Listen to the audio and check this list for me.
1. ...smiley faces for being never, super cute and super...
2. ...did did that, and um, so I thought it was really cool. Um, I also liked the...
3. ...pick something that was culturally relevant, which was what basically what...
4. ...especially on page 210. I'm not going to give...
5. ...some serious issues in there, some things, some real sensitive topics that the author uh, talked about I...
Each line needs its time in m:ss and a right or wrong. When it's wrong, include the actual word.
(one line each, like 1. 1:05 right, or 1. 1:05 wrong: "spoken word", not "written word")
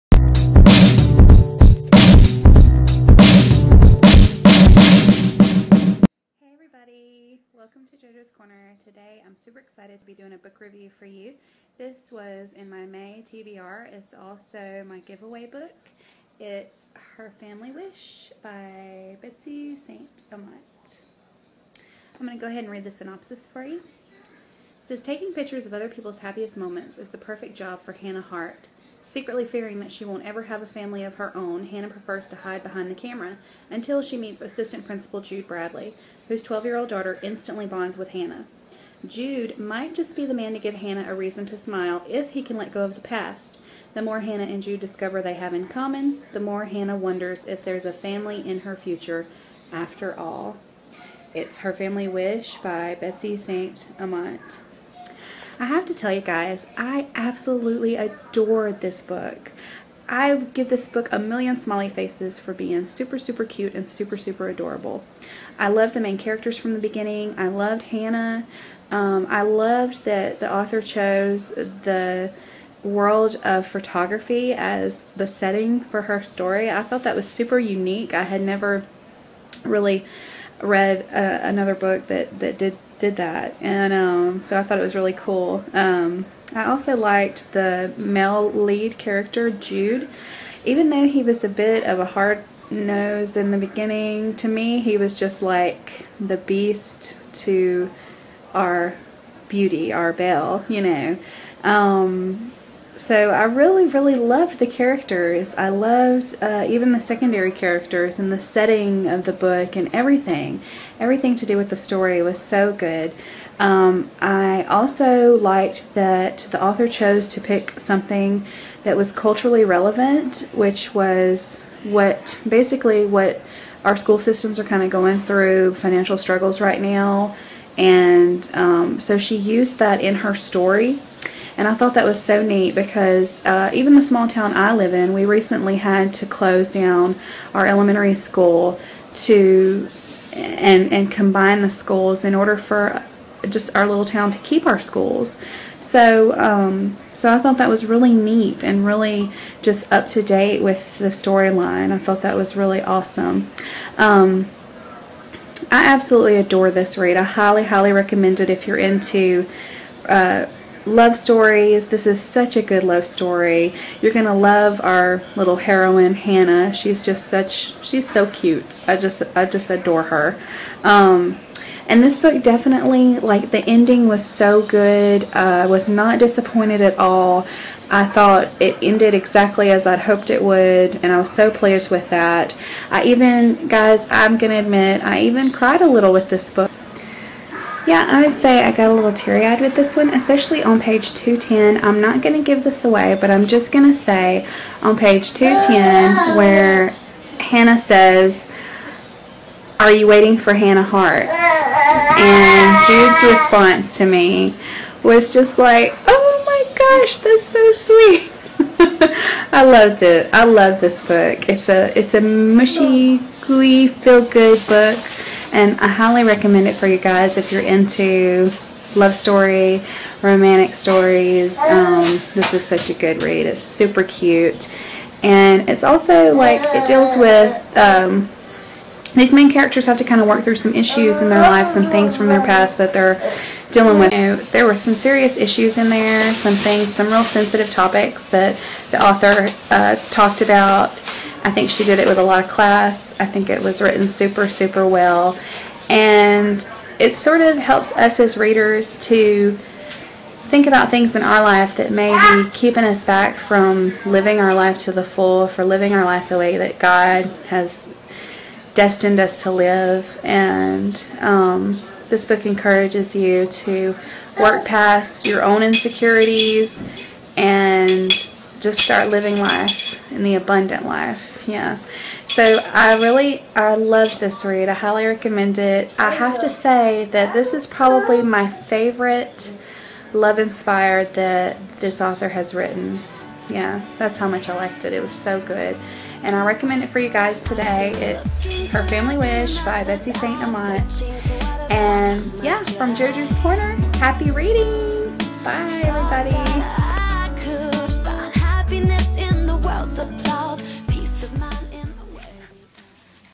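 1. 1:01 wrong: "super", not "never"
2. 1:22 right
3. 1:57 right
4. 3:10 right
5. 3:54 right.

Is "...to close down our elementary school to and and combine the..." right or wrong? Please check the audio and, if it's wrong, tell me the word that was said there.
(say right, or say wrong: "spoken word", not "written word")
right.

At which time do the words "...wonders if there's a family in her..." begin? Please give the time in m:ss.
0:46.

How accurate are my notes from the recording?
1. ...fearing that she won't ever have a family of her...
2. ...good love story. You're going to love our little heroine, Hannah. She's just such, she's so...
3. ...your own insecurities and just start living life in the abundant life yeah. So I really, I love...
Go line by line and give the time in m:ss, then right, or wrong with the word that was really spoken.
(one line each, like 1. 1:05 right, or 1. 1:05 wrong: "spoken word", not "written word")
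1. 0:29 right
2. 2:42 right
3. 4:25 right.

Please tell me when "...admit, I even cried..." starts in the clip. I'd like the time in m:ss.
3:04.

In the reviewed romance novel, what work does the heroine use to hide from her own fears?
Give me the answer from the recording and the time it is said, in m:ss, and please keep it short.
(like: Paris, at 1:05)
Photography, at 1:13.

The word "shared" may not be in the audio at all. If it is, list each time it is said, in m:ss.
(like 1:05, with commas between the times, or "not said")
not said.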